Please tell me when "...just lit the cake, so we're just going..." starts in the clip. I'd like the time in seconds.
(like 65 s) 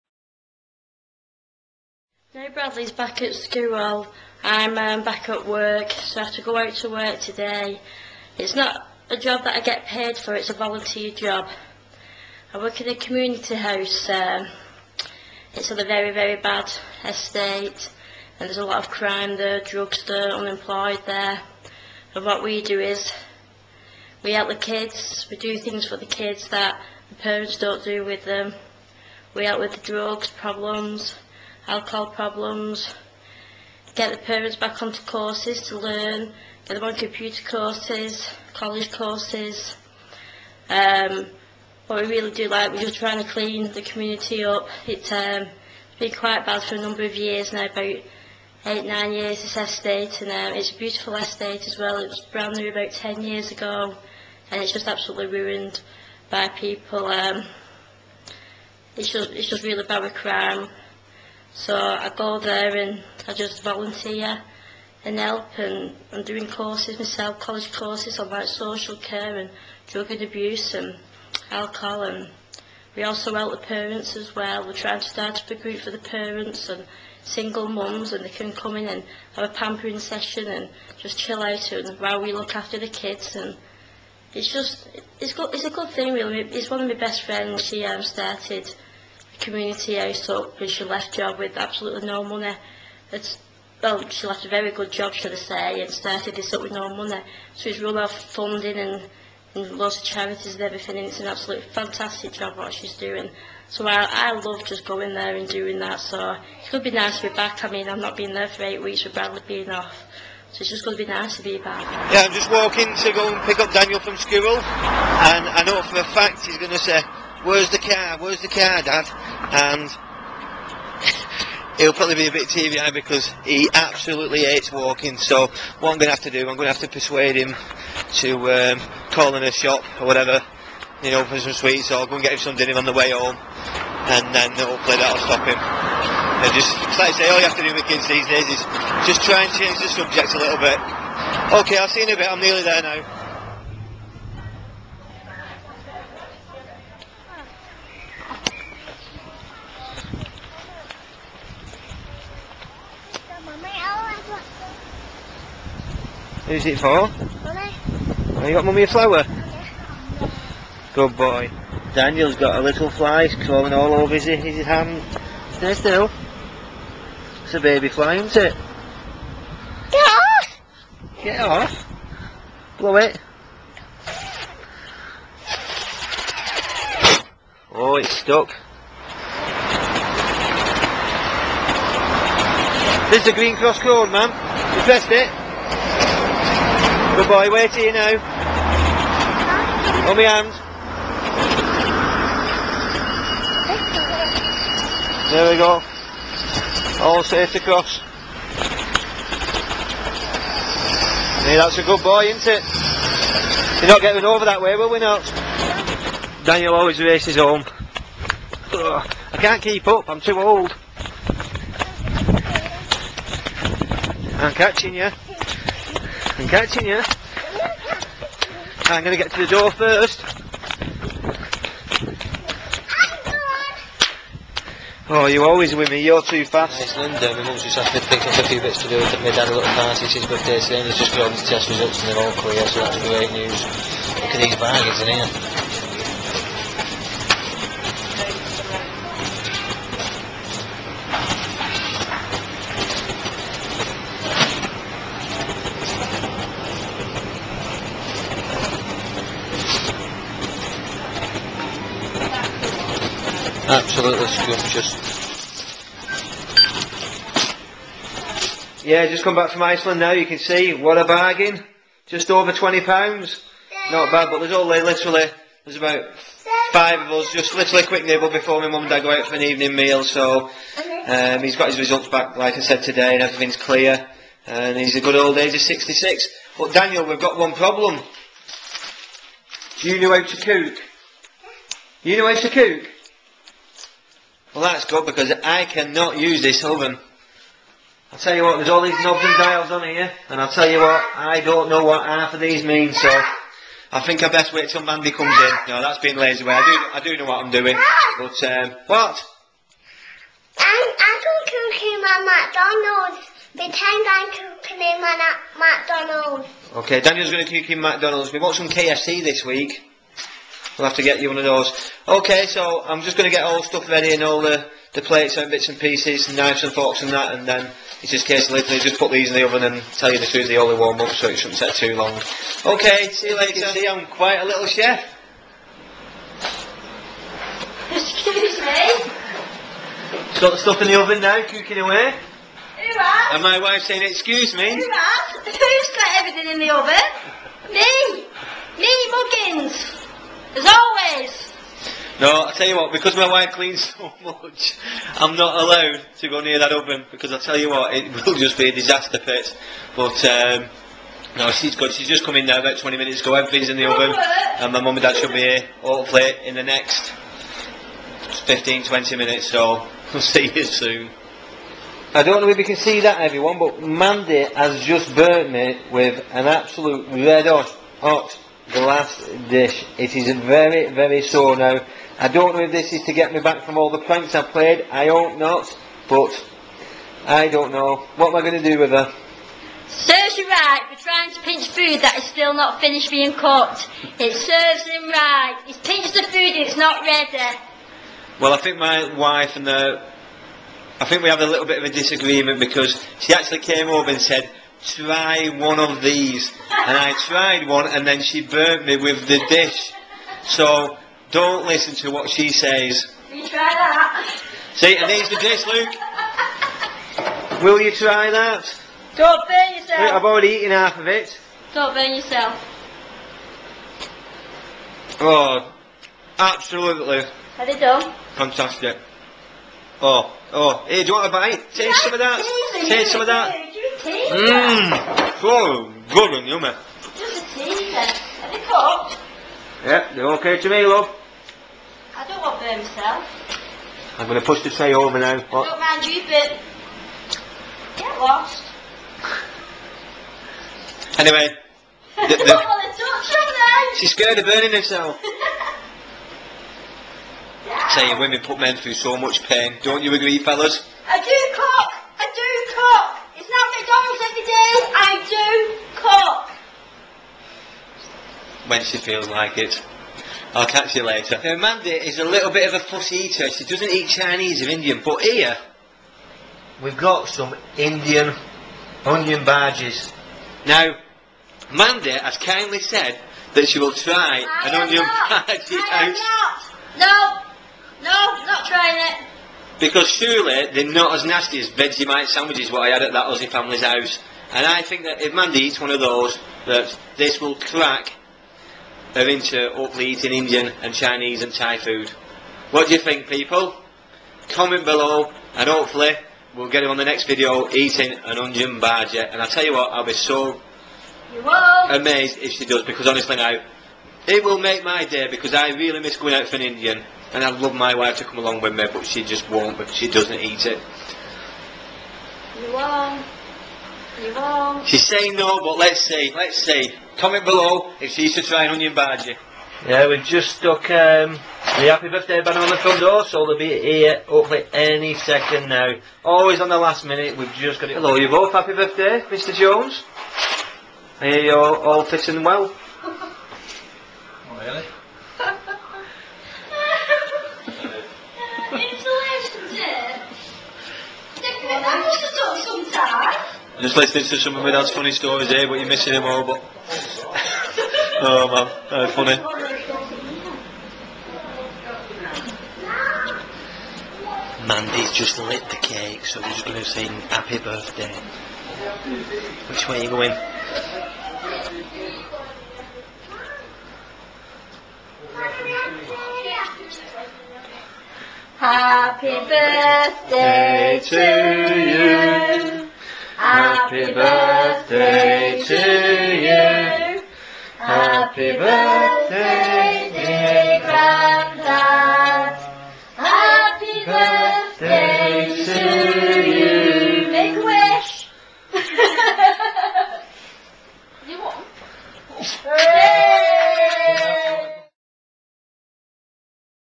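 555 s.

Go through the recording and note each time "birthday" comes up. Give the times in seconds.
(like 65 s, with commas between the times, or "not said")
230 s, 522 s, 528 s, 557 s, 569 s, 574 s, 578 s.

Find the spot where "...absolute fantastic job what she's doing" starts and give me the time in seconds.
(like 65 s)
101 s.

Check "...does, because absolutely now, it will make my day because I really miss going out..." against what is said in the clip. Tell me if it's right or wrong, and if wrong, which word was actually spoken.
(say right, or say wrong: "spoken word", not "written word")
wrong: "honestly", not "absolutely".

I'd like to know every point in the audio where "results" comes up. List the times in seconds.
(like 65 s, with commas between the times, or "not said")
231 s, 271 s.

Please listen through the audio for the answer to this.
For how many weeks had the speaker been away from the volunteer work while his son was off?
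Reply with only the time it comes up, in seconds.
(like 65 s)
108 s.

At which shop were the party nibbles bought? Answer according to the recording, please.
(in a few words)
Iceland.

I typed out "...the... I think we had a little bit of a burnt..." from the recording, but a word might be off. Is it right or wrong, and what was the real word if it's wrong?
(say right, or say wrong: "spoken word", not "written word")
wrong: "disagreement", not "burnt".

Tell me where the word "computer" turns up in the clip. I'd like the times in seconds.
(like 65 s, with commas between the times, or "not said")
36 s.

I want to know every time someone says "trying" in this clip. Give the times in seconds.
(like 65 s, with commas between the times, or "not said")
42 s, 74 s, 381 s, 478 s.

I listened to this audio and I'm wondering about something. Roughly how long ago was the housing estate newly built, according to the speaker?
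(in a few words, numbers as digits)
10 years.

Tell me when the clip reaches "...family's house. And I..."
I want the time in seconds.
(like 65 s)
483 s.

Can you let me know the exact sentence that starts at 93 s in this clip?
It's, well, she left a very good job, should I say, and started this up with no money.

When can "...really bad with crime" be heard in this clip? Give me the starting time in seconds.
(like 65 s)
59 s.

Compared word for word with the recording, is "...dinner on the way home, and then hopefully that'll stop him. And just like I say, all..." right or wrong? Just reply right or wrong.
right.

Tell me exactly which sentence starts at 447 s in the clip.
Saying women put men through so much pain.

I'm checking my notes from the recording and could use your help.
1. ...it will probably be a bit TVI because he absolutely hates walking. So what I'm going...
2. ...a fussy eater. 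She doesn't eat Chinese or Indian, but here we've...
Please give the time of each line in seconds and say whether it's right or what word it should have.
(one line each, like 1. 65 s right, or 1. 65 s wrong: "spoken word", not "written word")
1. 121 s right
2. 462 s right.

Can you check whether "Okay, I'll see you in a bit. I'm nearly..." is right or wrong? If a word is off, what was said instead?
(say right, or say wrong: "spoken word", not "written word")
right.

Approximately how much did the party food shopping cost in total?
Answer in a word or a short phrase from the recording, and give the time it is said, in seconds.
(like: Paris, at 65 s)
just over £20, at 262 s.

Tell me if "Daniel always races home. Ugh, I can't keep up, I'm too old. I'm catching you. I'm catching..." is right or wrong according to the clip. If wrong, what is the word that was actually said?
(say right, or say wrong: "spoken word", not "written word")
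right.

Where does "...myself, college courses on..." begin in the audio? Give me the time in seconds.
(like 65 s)
66 s.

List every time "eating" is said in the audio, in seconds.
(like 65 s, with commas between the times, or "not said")
490 s, 497 s.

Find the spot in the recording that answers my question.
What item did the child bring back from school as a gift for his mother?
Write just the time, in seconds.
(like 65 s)
158 s.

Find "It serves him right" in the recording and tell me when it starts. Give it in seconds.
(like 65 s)
384 s.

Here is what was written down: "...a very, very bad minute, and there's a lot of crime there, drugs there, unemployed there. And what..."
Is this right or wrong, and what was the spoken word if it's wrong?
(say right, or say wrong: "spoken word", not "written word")
wrong: "estate", not "minute".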